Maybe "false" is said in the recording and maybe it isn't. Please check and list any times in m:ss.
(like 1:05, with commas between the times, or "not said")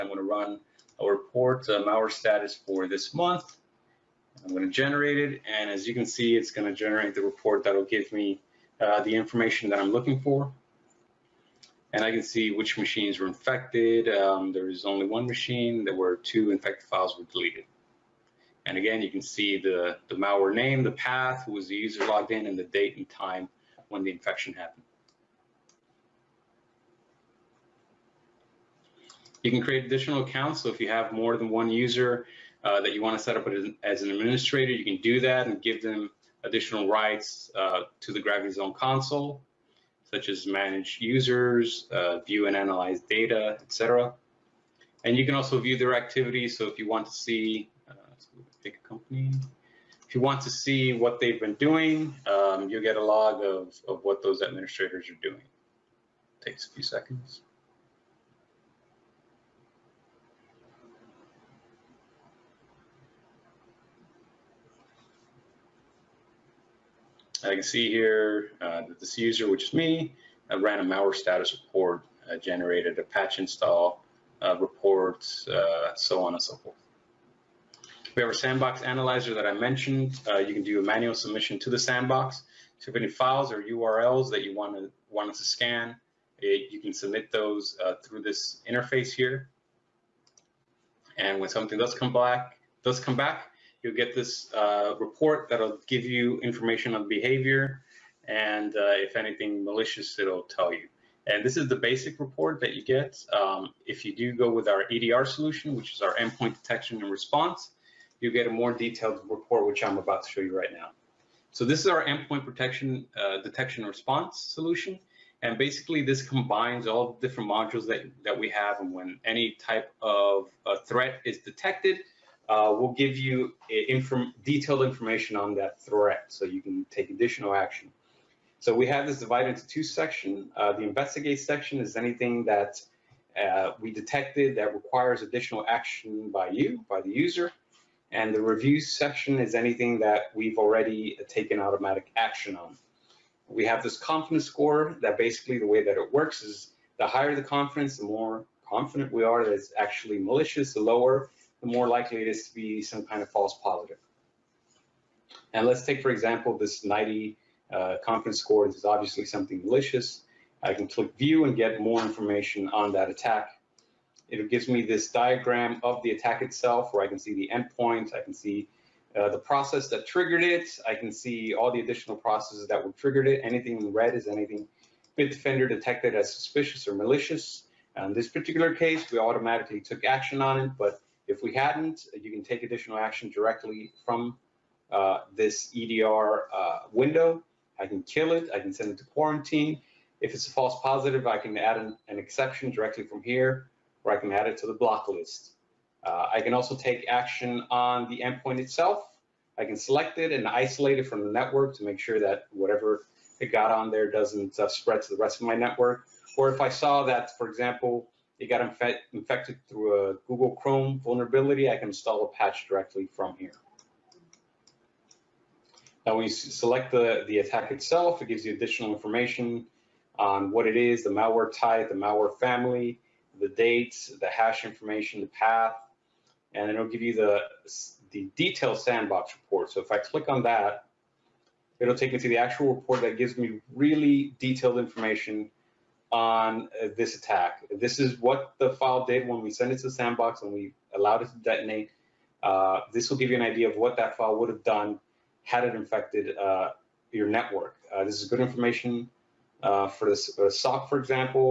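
2:33, 3:10.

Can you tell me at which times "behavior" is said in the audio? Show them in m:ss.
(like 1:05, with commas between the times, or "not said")
1:37.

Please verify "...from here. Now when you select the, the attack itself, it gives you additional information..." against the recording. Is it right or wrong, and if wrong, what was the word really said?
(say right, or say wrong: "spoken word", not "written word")
right.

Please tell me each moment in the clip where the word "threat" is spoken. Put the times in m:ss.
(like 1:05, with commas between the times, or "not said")
2:00, 2:05.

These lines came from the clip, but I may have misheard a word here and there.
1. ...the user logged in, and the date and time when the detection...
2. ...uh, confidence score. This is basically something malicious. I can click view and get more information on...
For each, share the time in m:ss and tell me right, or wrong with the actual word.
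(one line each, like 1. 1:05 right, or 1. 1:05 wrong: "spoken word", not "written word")
1. 0:21 wrong: "infection", not "detection"
2. 2:37 wrong: "obviously", not "basically".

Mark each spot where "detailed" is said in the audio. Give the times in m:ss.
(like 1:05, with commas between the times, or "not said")
1:48, 2:04, 3:48, 3:54.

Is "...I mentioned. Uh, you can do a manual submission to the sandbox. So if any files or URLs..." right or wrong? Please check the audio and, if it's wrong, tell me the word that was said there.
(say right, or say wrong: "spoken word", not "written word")
right.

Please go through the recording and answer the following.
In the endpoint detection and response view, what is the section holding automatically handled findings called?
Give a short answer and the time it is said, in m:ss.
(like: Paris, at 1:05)
Review, at 2:18.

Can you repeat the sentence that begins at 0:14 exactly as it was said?
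Um, there was only one machine.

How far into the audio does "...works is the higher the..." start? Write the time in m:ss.
2:26.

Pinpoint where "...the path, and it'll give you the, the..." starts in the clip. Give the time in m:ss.
3:45.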